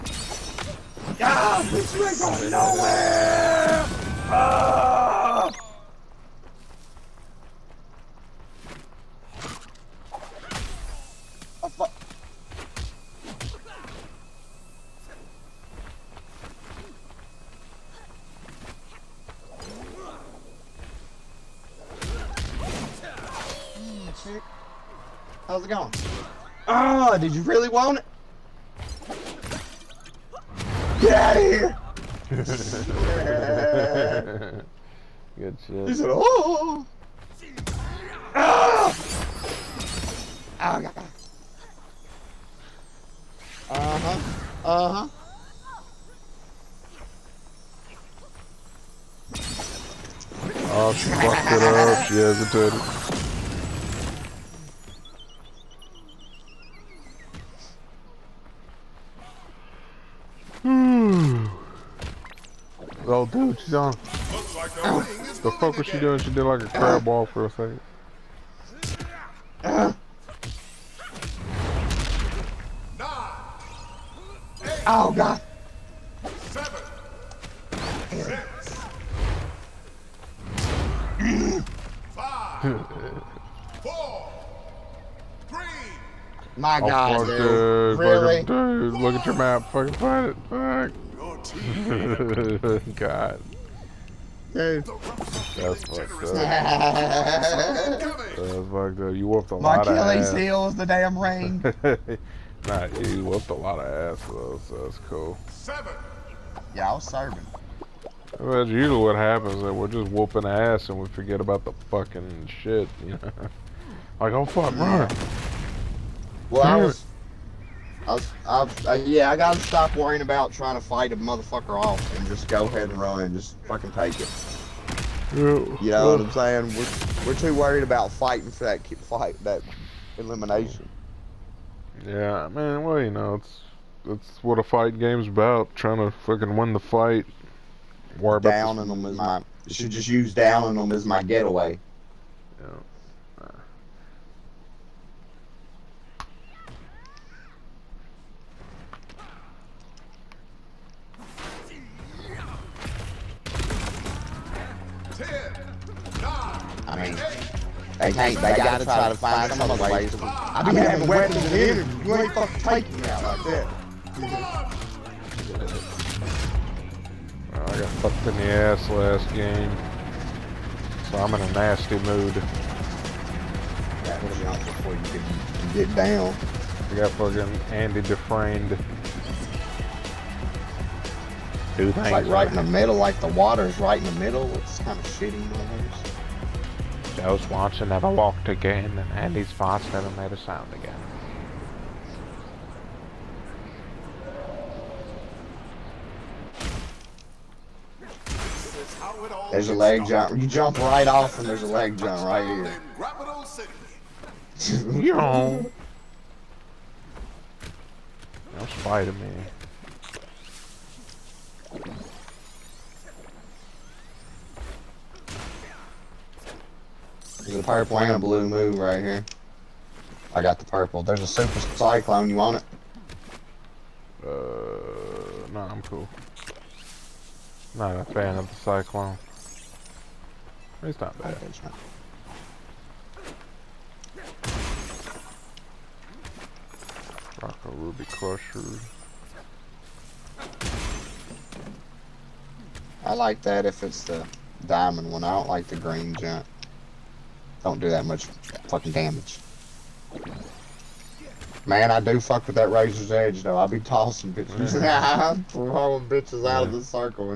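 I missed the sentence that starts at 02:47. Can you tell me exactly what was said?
I got fucked in the ass last game.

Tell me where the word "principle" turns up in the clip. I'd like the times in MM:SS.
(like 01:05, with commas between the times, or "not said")
not said.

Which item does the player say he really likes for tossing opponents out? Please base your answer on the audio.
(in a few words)
Razor's Edge.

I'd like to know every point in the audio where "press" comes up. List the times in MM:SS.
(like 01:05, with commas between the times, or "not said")
not said.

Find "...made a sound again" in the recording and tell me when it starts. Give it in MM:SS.
03:10.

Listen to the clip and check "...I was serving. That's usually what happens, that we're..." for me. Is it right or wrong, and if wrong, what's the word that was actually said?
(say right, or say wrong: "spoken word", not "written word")
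right.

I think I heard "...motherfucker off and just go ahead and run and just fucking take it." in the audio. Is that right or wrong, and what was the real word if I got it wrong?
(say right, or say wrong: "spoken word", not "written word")
right.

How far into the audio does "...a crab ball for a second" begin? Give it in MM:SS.
01:06.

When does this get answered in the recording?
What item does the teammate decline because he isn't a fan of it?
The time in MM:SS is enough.
03:41.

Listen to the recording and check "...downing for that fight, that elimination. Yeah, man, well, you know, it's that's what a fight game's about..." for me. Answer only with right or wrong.
wrong.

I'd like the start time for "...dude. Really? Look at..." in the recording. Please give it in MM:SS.
01:27.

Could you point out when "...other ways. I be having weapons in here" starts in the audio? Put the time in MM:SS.
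02:39.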